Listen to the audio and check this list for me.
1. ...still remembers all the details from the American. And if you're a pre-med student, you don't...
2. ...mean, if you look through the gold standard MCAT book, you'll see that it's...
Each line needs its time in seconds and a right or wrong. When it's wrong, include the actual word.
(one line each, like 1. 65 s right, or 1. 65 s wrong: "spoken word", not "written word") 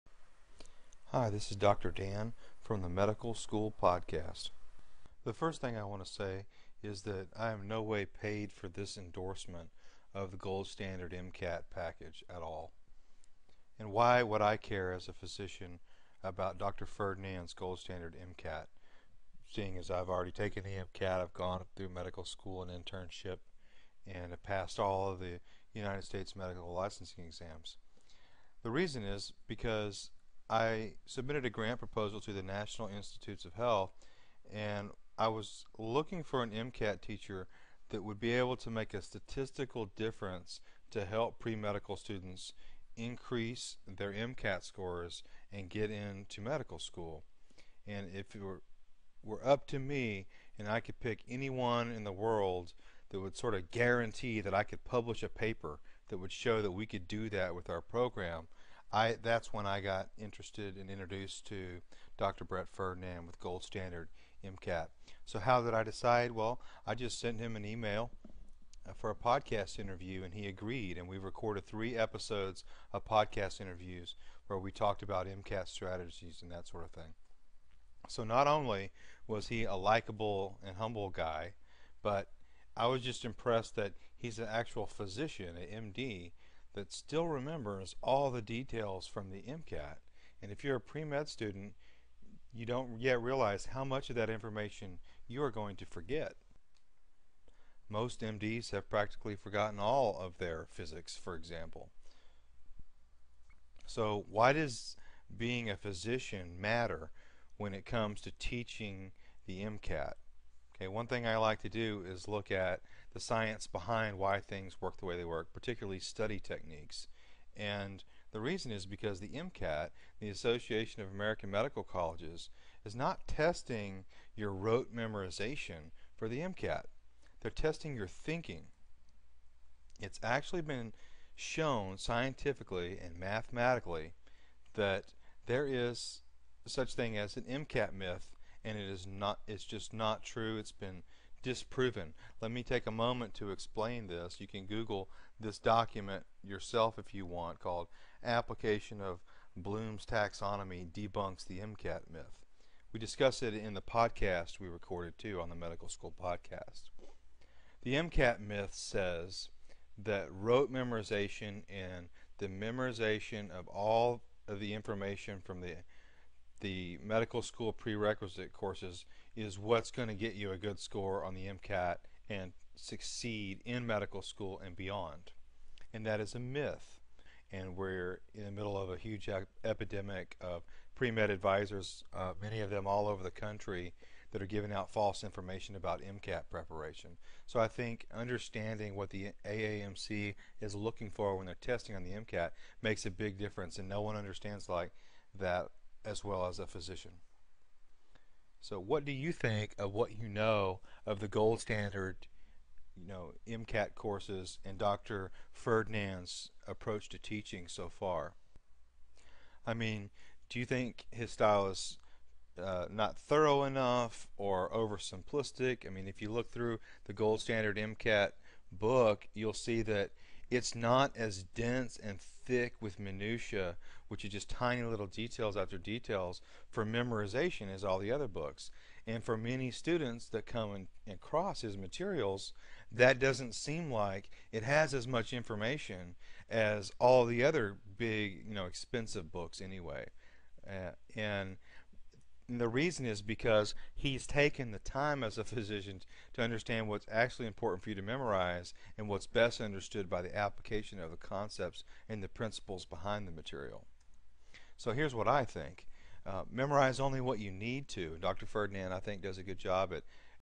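1. 86 s wrong: "MCAT", not "American"
2. 215 s right.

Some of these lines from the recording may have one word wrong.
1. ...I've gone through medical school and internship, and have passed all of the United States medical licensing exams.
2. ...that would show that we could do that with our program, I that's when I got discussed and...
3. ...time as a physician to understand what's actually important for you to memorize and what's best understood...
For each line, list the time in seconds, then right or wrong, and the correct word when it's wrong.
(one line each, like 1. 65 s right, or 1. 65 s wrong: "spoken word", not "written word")
1. 21 s right
2. 56 s wrong: "interested", not "discussed"
3. 244 s right.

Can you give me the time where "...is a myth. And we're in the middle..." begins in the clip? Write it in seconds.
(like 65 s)
176 s.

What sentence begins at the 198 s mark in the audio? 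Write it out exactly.
So what do you think of what you know of the gold standard, you know, MCAT courses and Dr.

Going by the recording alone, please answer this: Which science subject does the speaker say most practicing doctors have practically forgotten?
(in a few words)
physics.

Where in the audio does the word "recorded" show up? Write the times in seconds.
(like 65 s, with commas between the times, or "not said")
71 s, 154 s.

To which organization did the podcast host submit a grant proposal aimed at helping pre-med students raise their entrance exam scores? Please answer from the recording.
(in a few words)
National Institutes of Health.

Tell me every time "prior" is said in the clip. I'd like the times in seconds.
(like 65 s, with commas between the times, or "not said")
not said.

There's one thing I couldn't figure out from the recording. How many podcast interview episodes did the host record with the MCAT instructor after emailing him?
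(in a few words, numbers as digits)
3.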